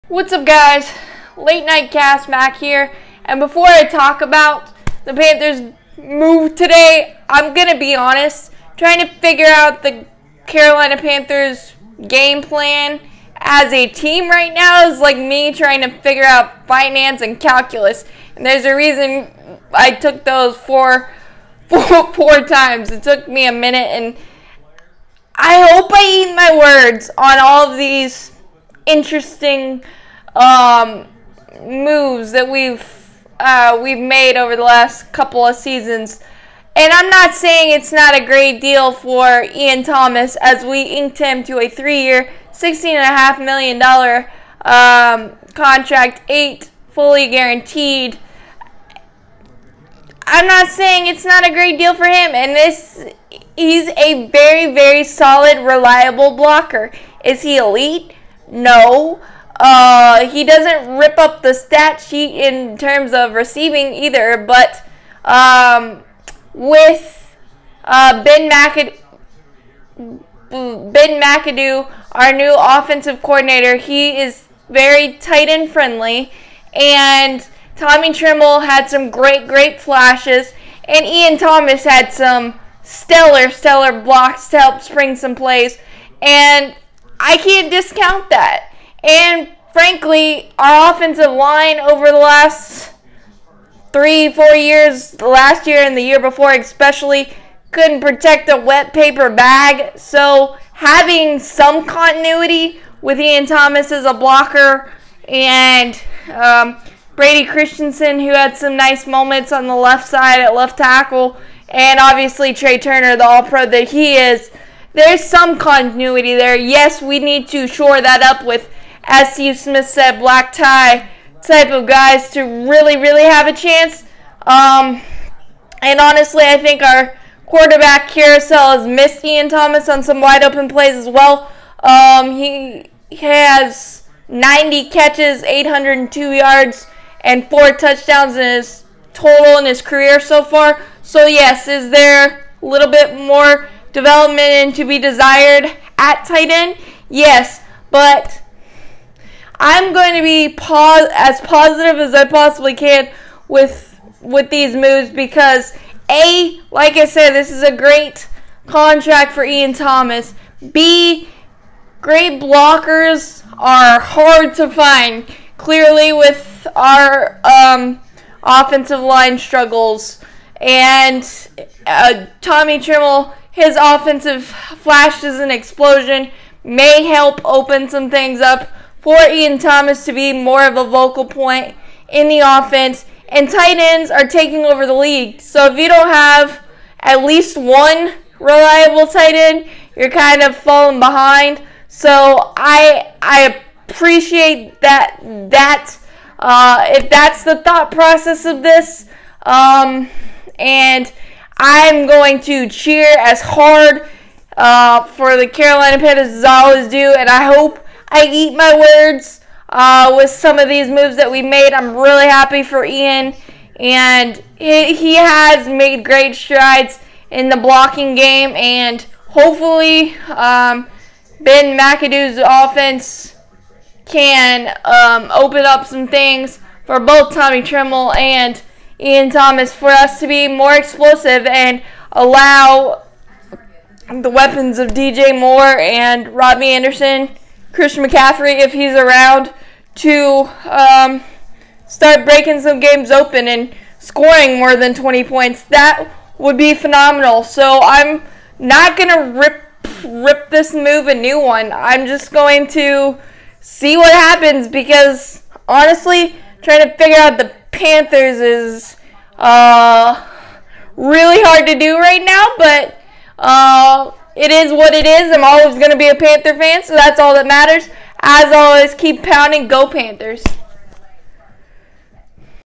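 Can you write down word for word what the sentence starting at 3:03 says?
And tight ends are taking over the league.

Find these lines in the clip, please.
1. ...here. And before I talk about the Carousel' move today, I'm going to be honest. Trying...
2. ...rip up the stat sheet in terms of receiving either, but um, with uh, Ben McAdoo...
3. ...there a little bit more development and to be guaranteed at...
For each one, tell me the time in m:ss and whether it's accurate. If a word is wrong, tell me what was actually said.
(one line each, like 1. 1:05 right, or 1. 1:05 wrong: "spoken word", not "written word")
1. 0:02 wrong: "Panthers", not "Carousel"
2. 1:00 right
3. 2:21 wrong: "desired", not "guaranteed".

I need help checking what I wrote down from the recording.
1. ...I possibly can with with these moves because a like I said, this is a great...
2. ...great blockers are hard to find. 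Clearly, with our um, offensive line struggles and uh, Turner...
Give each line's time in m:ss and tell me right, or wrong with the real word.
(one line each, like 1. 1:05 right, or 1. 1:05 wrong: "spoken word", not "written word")
1. 2:32 right
2. 2:42 wrong: "Tommy", not "Turner".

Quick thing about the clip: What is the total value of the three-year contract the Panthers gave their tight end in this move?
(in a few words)
$16.5 million.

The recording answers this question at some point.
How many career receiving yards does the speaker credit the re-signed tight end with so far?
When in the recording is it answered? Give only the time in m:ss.
2:15.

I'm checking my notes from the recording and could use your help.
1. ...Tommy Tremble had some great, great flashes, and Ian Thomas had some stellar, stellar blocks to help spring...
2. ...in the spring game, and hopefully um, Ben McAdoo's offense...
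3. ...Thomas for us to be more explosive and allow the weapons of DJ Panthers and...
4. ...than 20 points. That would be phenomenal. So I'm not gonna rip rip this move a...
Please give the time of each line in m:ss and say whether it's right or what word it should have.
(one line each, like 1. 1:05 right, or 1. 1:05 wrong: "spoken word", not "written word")
1. 1:17 right
2. 3:37 wrong: "blocking", not "spring"
3. 3:49 wrong: "Moore", not "Panthers"
4. 4:04 right.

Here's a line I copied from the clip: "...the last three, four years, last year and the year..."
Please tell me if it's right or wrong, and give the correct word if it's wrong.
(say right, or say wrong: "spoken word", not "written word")
right.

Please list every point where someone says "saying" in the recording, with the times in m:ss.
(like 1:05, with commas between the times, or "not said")
0:37, 0:50.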